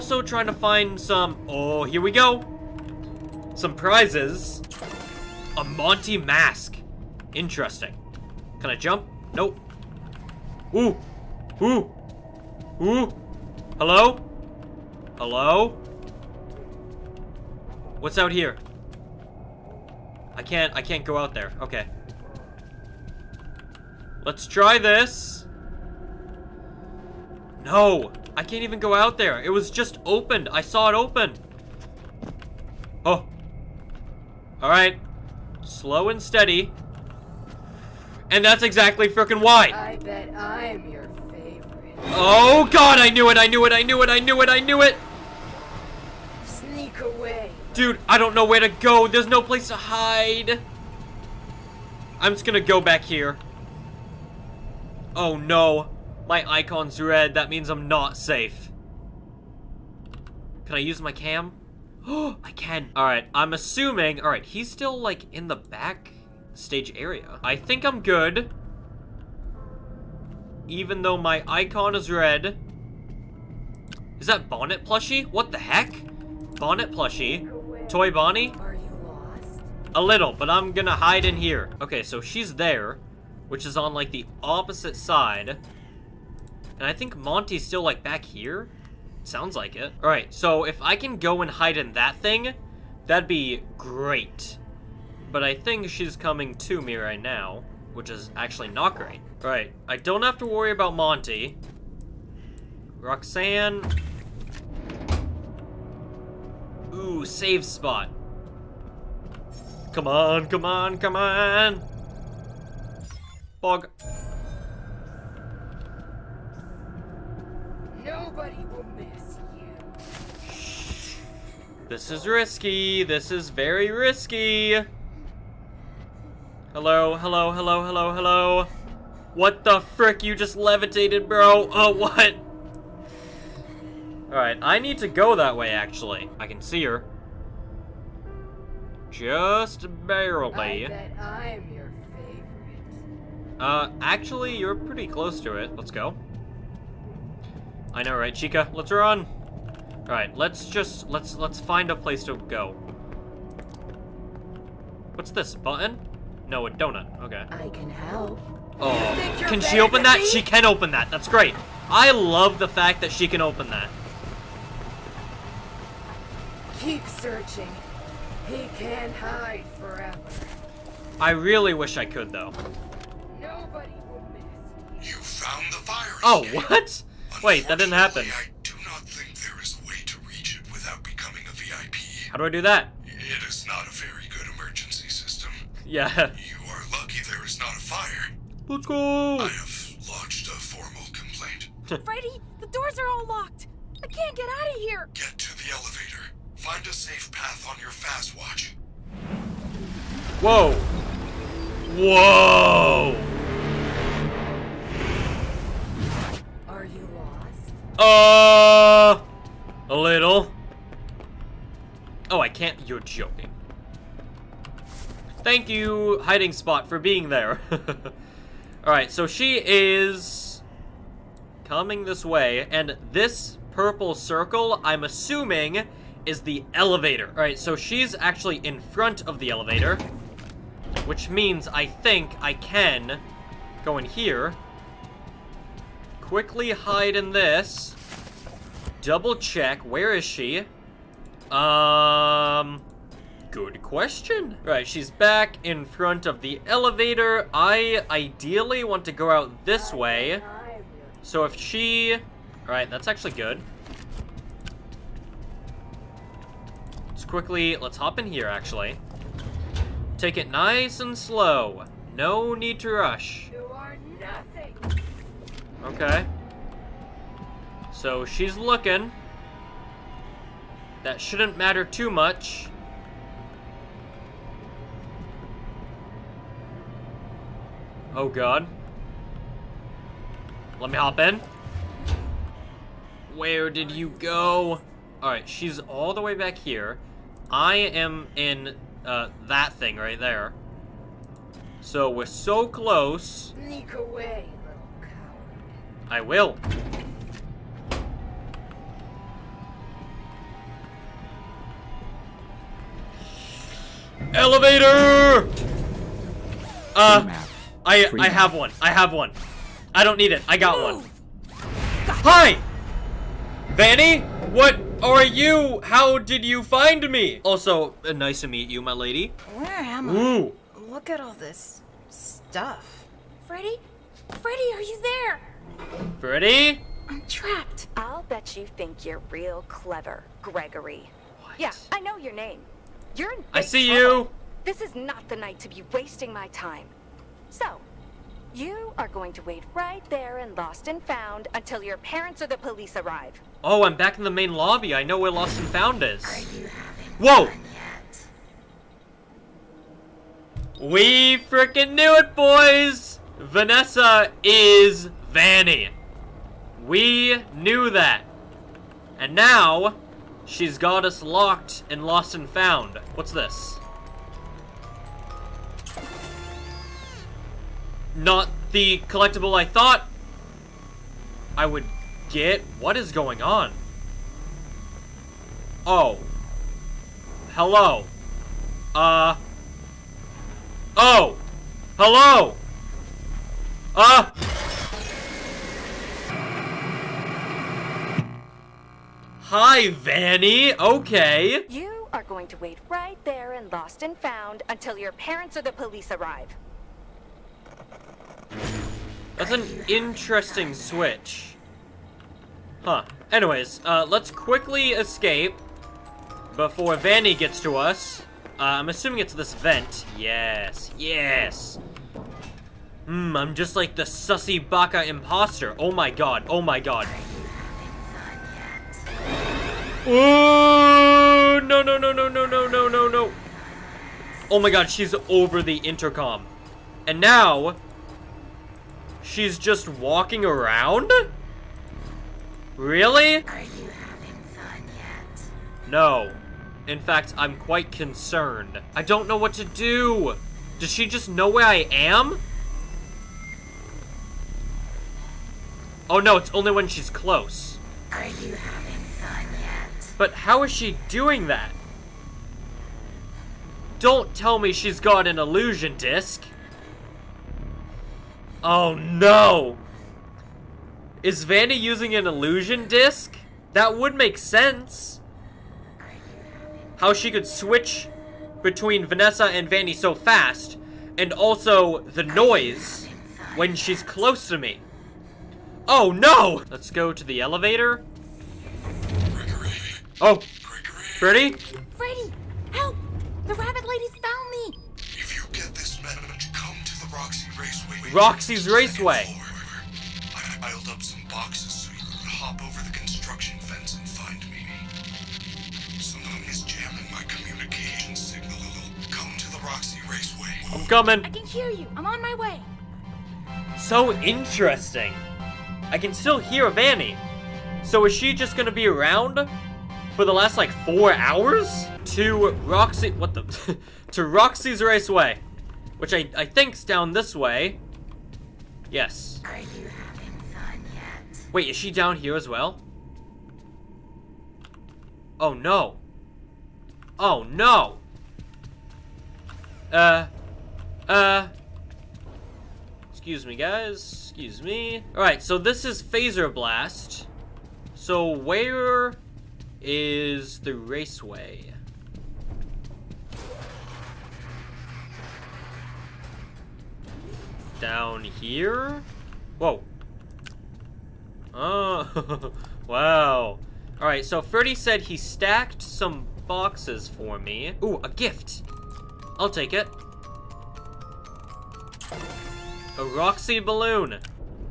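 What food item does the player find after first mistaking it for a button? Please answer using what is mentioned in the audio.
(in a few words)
A donut.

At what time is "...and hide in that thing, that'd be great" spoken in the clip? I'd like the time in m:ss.
1:31.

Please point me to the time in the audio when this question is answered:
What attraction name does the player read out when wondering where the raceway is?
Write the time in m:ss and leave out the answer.
8:56.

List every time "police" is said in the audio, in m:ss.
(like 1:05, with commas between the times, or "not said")
5:42, 6:35.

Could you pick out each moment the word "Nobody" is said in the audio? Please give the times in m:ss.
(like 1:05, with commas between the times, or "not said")
1:58, 2:53.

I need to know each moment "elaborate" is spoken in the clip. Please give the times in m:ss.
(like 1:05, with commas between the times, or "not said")
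not said.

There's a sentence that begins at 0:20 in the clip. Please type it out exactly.
I can't, I can't go out there.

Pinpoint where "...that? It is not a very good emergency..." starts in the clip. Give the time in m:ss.
3:02.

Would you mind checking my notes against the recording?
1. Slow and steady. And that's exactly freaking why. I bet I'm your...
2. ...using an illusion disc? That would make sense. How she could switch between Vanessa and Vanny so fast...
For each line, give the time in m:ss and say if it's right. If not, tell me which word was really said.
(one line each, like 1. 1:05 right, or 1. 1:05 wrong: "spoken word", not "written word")
1. 0:35 right
2. 7:41 right.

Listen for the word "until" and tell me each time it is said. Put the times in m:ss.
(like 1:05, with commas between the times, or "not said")
5:41, 6:34.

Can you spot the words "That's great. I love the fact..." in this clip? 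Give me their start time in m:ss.
2:41.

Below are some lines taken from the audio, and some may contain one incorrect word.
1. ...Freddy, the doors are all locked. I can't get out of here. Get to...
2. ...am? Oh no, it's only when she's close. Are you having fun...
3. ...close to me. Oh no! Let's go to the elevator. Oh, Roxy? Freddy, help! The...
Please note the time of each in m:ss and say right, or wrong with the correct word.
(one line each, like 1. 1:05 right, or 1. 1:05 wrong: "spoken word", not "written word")
1. 3:12 right
2. 7:21 right
3. 7:54 wrong: "Freddy", not "Roxy".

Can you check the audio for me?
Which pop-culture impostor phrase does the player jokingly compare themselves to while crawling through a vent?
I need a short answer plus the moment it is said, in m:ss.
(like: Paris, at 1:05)
sussy baka imposter, at 6:54.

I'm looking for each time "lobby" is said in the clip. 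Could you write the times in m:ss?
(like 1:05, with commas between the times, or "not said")
5:44.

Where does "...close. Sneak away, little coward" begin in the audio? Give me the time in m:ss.
4:52.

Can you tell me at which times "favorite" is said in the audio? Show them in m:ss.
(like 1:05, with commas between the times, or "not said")
0:41, 2:22.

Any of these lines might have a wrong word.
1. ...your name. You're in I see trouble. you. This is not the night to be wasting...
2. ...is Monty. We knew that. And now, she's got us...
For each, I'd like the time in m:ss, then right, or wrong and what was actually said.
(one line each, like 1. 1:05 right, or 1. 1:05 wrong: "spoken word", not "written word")
1. 5:32 right
2. 5:54 wrong: "Vanny", not "Monty".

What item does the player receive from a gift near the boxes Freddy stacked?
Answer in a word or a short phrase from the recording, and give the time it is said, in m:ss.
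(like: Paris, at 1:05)
A Roxy balloon, at 9:22.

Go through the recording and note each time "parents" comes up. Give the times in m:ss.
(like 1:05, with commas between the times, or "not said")
5:41, 6:35.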